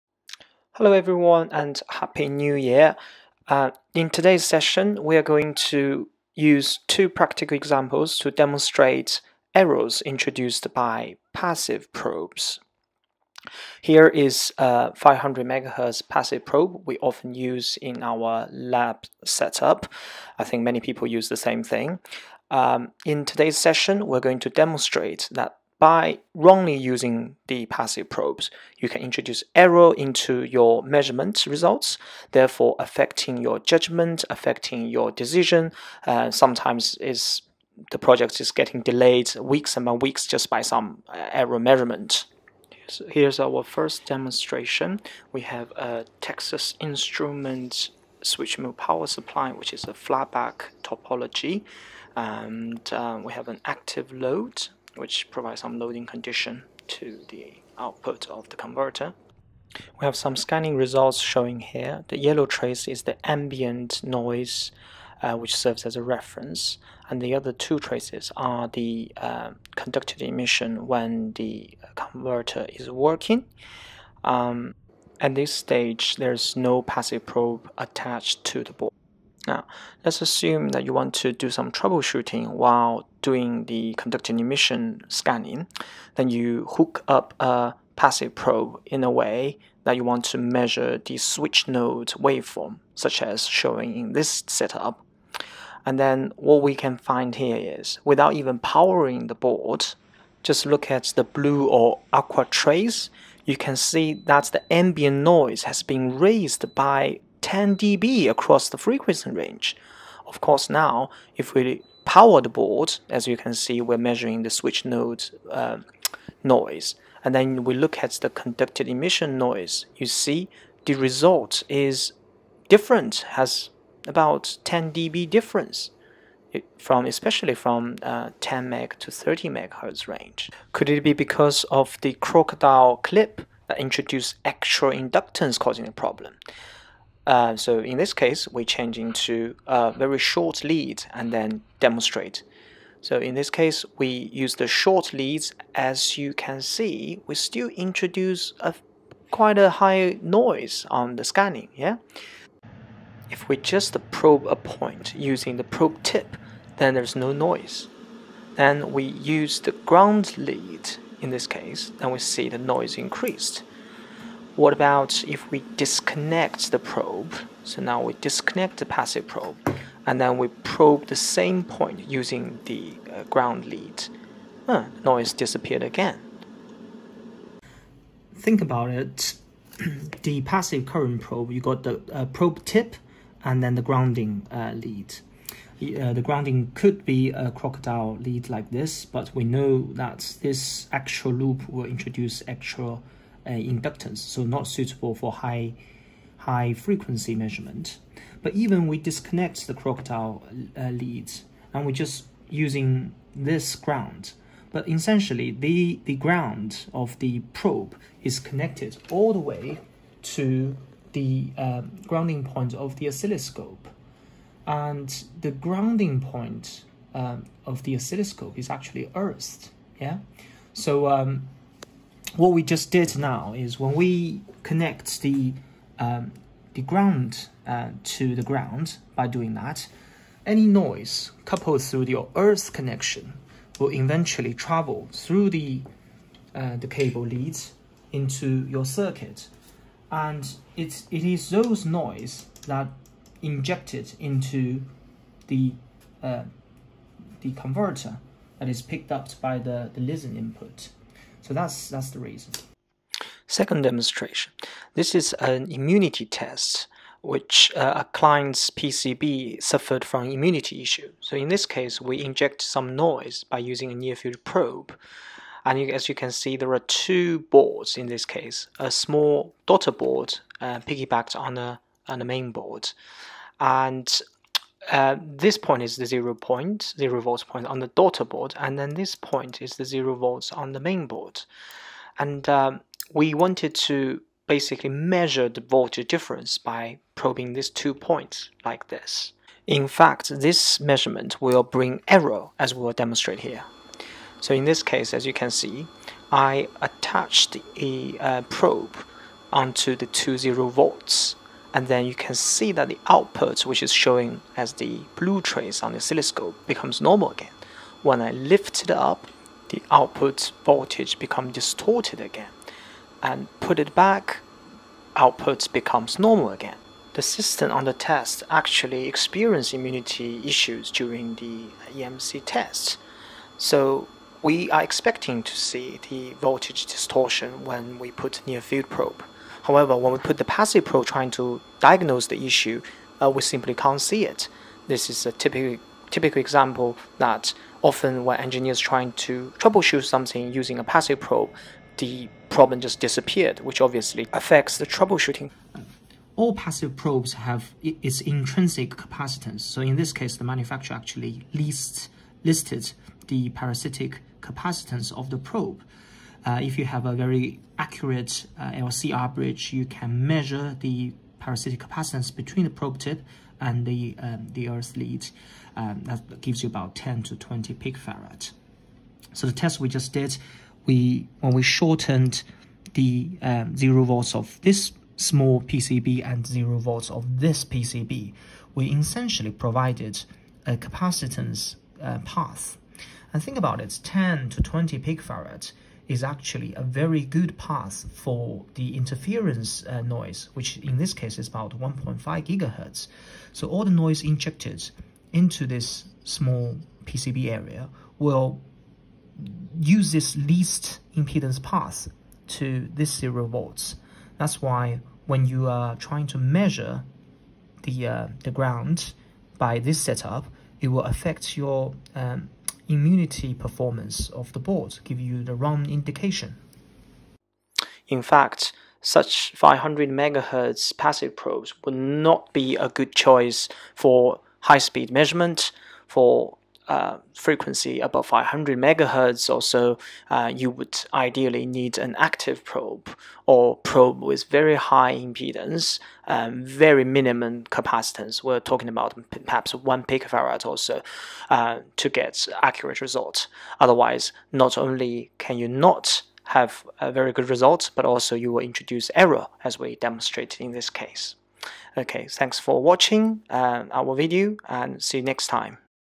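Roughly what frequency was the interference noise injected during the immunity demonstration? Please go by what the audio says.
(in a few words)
1.5 GHz.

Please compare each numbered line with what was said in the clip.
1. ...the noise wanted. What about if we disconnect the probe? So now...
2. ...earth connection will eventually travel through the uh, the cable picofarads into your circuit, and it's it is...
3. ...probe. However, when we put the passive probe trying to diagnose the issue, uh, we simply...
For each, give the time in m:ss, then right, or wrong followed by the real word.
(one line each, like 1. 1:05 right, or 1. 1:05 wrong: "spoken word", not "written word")
1. 2:42 wrong: "increased", not "wanted"
2. 3:52 wrong: "leads", not "picofarads"
3. 5:28 right.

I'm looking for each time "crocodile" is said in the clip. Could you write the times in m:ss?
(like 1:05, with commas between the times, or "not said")
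2:12, 3:07, 3:19.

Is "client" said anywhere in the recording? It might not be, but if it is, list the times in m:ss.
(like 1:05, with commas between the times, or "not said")
4:18.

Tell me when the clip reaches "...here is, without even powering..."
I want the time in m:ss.
1:37.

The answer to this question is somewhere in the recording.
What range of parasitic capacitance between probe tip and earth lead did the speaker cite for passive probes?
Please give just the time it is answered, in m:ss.
6:06.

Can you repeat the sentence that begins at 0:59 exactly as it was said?
We have some scanning results showing here.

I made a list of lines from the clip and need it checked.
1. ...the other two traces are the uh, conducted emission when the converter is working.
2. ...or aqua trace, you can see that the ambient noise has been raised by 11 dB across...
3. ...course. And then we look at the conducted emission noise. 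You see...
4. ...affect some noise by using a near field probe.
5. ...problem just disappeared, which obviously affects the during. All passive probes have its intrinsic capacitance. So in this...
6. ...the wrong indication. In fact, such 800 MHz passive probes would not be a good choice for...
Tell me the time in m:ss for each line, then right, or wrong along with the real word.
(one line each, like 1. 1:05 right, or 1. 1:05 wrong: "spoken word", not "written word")
1. 1:07 right
2. 1:41 wrong: "10", not "11"
3. 1:56 wrong: "noise", not "course"
4. 4:22 wrong: "inject", not "affect"
5. 5:42 wrong: "troubleshooting", not "during"
6. 6:55 wrong: "500", not "800".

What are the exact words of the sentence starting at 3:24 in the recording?
But essentially, the, the ground of the probe is connected all the way to the uh, grounding point of the oscilloscope.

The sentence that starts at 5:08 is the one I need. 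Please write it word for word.
When I lift it up, the output voltage becomes distorted again and put it back, output becomes normal again.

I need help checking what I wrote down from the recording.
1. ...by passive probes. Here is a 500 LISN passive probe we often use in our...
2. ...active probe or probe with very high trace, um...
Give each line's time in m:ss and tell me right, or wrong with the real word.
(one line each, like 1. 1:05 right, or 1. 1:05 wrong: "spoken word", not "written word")
1. 0:10 wrong: "MHz", not "LISN"
2. 7:12 wrong: "impedance", not "trace".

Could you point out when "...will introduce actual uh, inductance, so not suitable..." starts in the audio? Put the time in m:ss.
3:11.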